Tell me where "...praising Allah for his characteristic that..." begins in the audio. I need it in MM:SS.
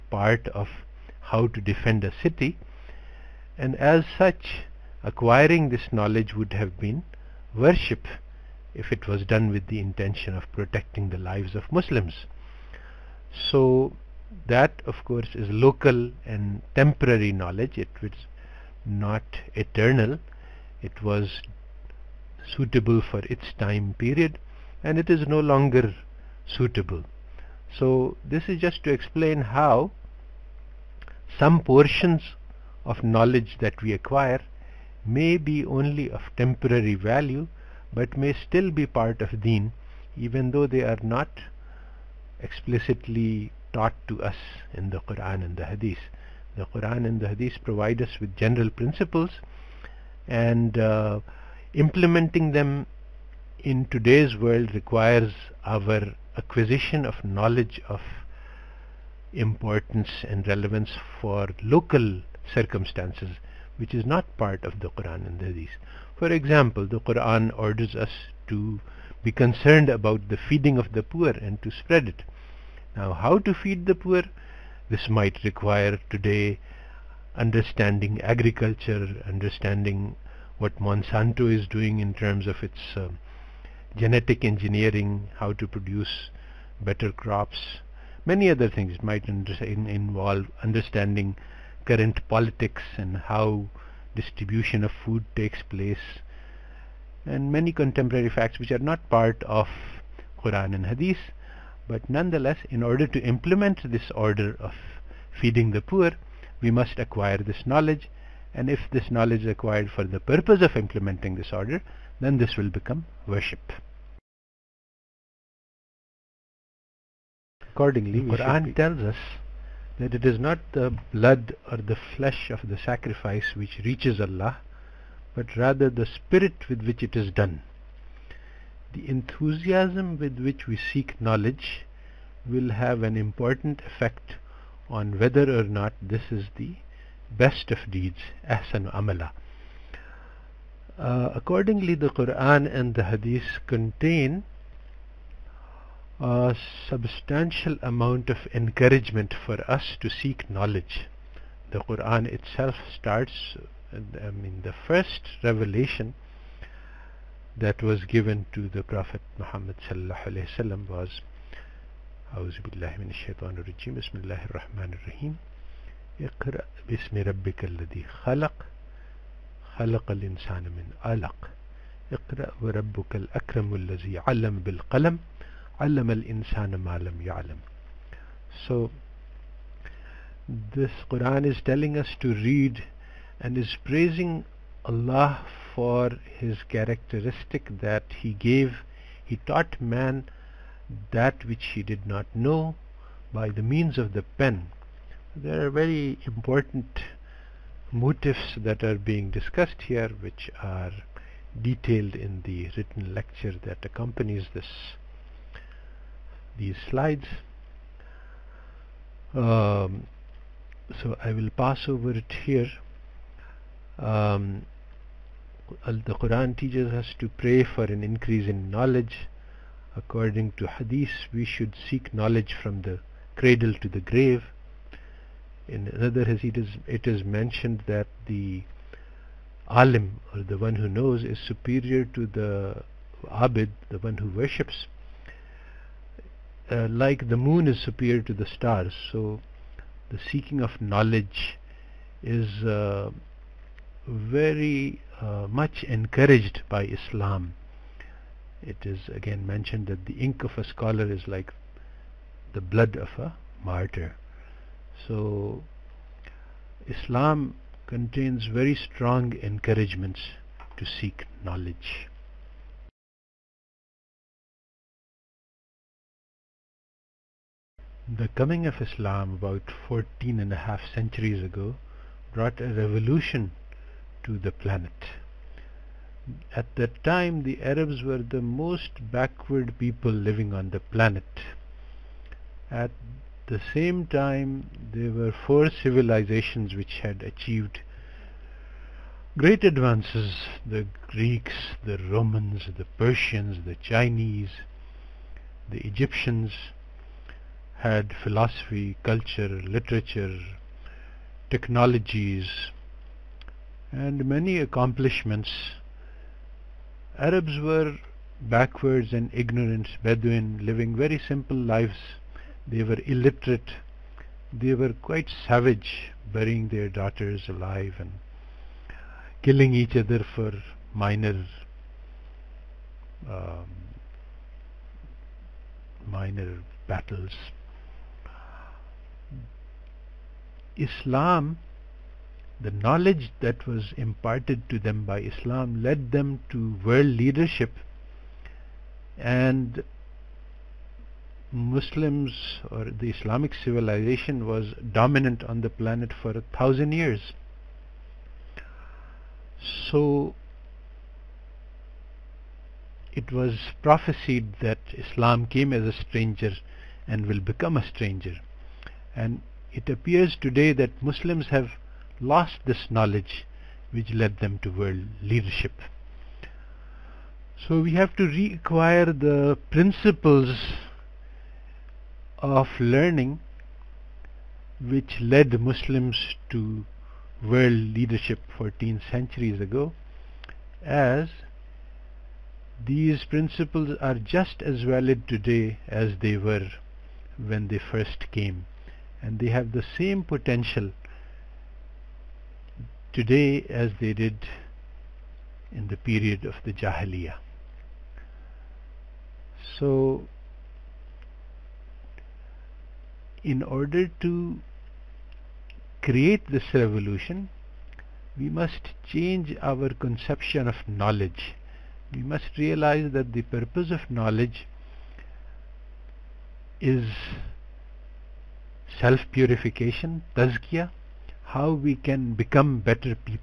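03:03.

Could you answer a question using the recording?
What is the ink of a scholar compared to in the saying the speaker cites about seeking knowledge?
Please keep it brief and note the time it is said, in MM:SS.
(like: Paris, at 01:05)
the blood of a martyr, at 04:12.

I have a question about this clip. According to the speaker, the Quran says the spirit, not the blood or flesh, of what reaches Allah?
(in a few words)
the sacrifice.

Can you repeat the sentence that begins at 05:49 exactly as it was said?
So it was prophesied that Islam came as a stranger and will become a stranger.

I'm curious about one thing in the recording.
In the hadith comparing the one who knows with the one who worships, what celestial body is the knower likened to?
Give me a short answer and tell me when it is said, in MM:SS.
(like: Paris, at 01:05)
the moon, at 03:57.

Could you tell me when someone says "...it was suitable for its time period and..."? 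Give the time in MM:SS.
00:20.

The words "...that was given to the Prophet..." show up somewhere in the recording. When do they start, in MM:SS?
02:37.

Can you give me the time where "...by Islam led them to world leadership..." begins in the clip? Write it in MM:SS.
05:35.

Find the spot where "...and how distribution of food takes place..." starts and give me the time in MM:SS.
01:32.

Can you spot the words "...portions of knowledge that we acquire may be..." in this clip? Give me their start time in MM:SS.
00:31.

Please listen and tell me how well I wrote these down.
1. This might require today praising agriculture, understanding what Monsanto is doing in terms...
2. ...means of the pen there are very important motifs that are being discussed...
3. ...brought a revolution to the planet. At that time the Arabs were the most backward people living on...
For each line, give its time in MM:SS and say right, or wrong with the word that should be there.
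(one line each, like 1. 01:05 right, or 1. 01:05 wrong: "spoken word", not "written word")
1. 01:14 wrong: "understanding", not "praising"
2. 03:13 right
3. 04:32 right.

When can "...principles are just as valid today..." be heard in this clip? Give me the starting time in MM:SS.
06:23.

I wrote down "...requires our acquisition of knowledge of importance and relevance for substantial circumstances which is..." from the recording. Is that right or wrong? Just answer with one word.
wrong.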